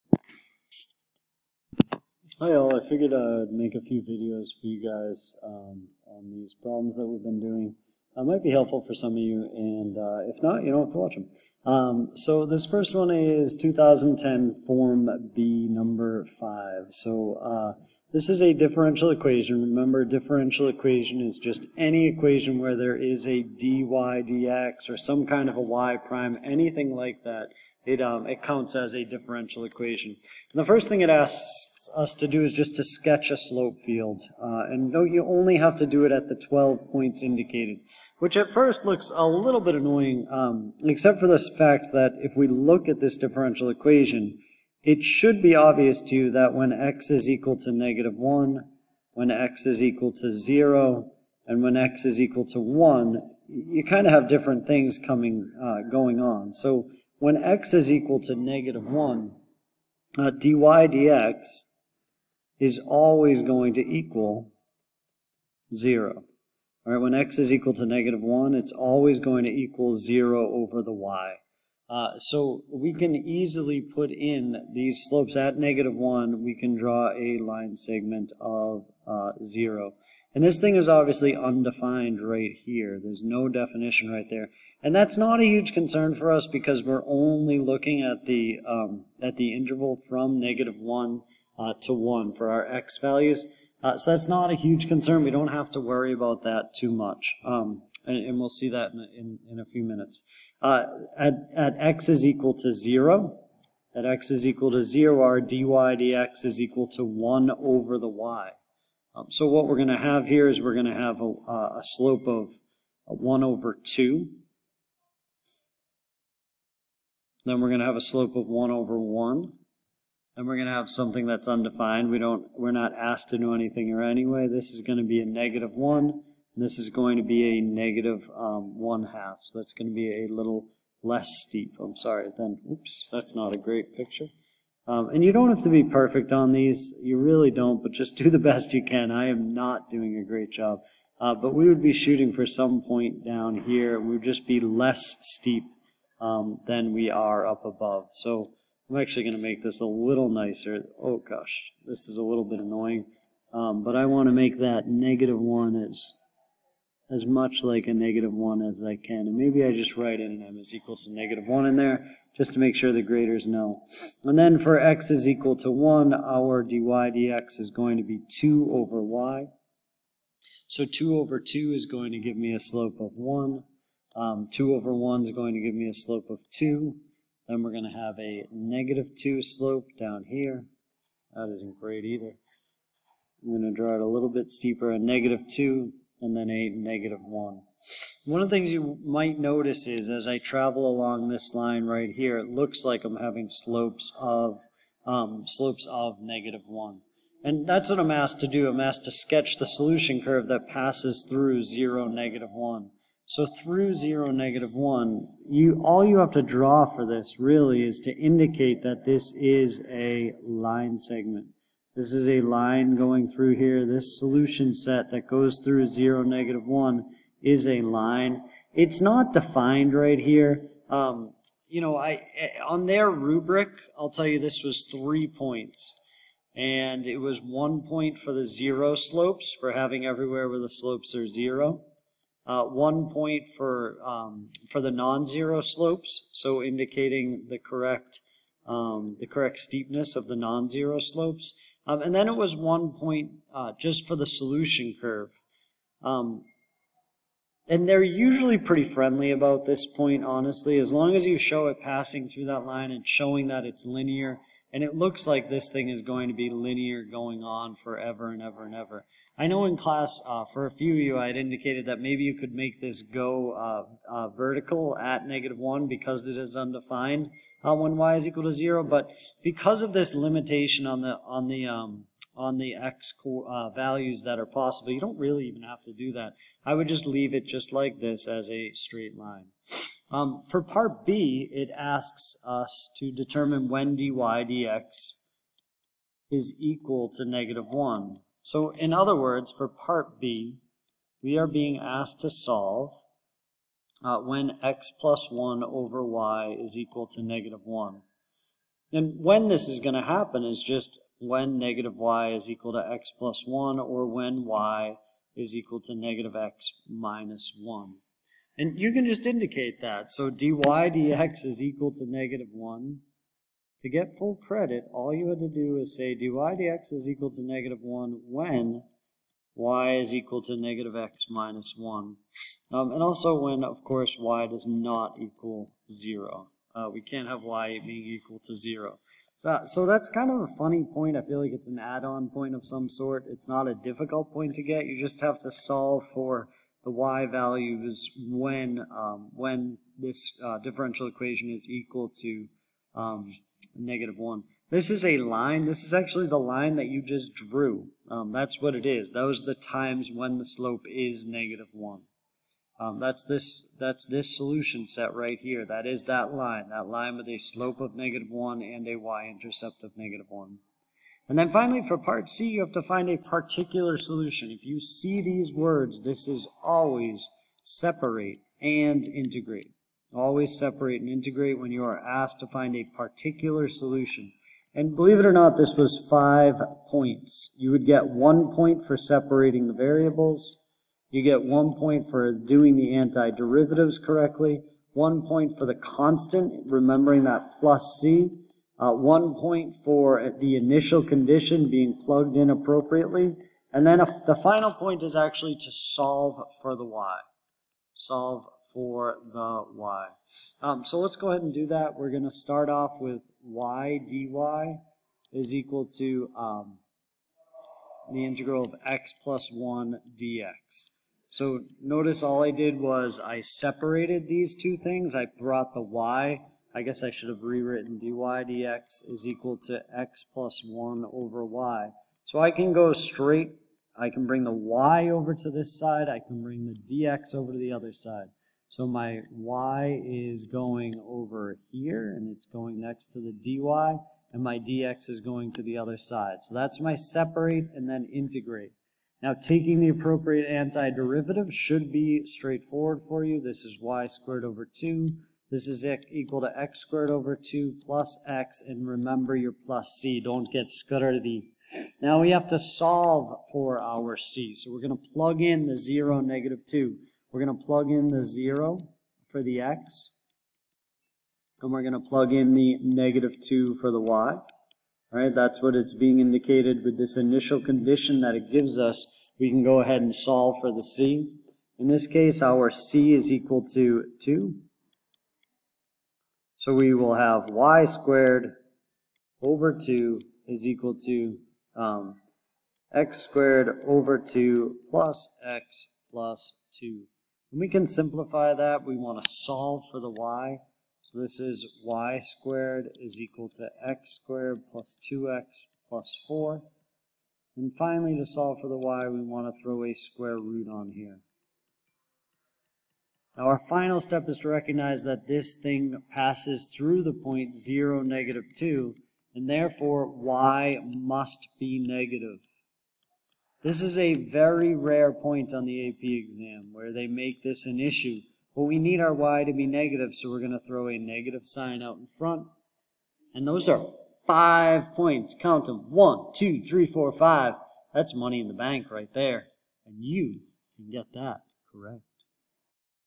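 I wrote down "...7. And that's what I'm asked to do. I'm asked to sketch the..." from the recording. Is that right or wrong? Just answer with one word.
wrong.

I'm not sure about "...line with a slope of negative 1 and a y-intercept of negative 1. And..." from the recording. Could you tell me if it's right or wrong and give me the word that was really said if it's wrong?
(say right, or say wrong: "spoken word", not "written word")
right.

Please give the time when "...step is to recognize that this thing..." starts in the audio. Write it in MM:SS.
08:24.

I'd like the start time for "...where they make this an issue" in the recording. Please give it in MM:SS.
08:36.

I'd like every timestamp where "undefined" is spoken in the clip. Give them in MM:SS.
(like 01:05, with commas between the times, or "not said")
01:21, 02:01, 04:26.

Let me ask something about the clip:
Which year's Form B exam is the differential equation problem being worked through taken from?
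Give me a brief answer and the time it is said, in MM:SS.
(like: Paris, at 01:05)
2010, at 00:13.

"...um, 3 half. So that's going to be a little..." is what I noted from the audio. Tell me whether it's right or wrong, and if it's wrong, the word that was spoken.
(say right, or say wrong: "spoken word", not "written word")
wrong: "1", not "3".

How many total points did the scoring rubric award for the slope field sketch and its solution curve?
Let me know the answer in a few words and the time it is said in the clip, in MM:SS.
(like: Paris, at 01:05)
3, at 03:44.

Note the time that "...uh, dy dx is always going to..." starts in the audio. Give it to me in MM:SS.
01:00.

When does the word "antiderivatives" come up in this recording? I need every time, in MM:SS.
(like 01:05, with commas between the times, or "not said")
06:22, 07:20.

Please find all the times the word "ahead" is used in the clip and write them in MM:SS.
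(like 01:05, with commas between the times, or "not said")
06:41, 07:49.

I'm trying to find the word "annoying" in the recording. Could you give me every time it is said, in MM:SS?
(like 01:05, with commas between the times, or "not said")
00:39, 02:32.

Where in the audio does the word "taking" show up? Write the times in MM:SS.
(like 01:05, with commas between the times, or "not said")
07:19.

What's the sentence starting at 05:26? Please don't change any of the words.
Uh, we can't have y being equal to 0.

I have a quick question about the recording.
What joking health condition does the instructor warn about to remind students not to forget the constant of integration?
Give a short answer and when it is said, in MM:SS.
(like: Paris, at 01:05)
scurvy, at 07:30.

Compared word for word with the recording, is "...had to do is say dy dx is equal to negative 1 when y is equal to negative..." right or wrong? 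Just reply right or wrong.
right.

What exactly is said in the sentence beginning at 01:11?
Uh, so we can easily put in these slopes at negative 1.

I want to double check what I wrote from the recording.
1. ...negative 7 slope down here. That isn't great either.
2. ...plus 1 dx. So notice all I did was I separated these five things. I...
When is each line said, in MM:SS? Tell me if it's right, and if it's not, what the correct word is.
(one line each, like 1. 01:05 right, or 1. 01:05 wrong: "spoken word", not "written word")
1. 02:58 wrong: "2", not "7"
2. 06:49 wrong: "two", not "five".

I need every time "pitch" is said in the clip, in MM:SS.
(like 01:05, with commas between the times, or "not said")
not said.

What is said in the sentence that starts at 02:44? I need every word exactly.
And then for x is equal to 1, our dy dx is going to be 2 over y.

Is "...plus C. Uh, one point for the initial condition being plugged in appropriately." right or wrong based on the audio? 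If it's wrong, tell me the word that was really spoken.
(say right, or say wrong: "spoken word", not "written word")
right.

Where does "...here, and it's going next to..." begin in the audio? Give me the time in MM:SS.
07:11.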